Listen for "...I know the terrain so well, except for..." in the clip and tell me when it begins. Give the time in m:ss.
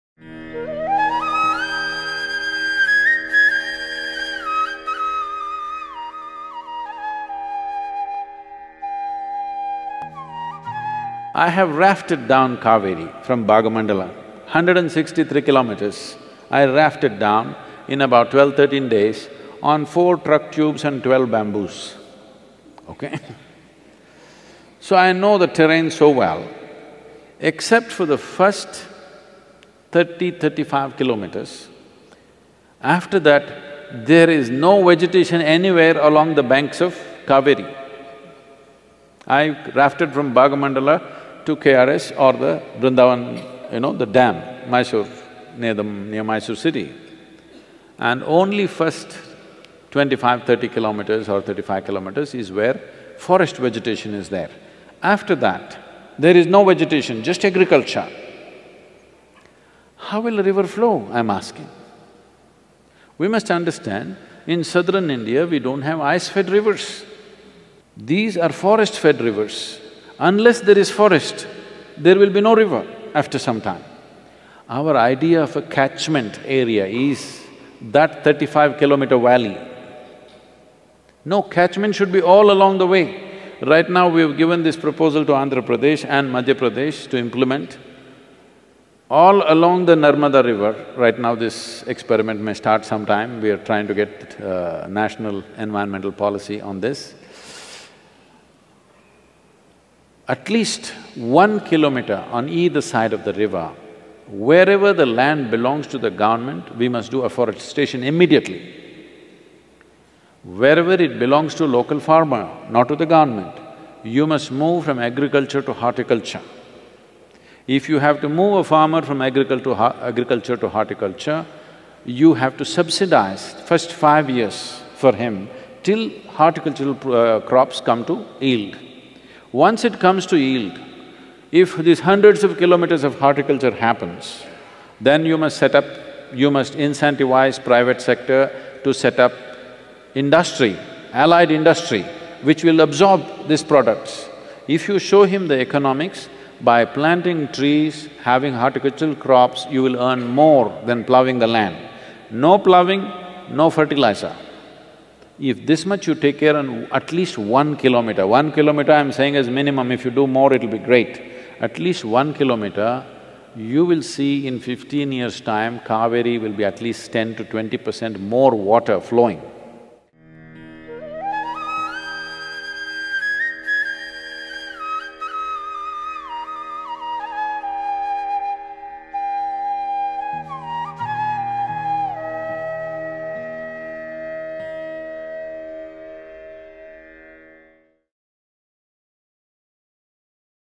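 0:24.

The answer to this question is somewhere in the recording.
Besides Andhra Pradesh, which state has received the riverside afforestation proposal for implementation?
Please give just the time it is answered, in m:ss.
1:26.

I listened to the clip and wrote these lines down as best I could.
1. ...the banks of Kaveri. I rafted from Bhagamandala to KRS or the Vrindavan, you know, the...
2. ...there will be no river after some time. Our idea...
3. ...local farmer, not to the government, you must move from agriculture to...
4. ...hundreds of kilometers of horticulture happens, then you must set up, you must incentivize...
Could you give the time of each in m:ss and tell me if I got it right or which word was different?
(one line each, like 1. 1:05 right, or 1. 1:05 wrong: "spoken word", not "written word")
1. 0:36 right
2. 1:11 right
3. 1:51 right
4. 2:11 right.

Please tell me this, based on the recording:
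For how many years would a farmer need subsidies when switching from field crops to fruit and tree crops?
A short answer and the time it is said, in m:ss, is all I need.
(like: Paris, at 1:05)
5, at 2:03.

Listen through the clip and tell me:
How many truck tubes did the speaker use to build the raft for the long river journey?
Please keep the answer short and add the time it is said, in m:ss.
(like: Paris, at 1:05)
4, at 0:19.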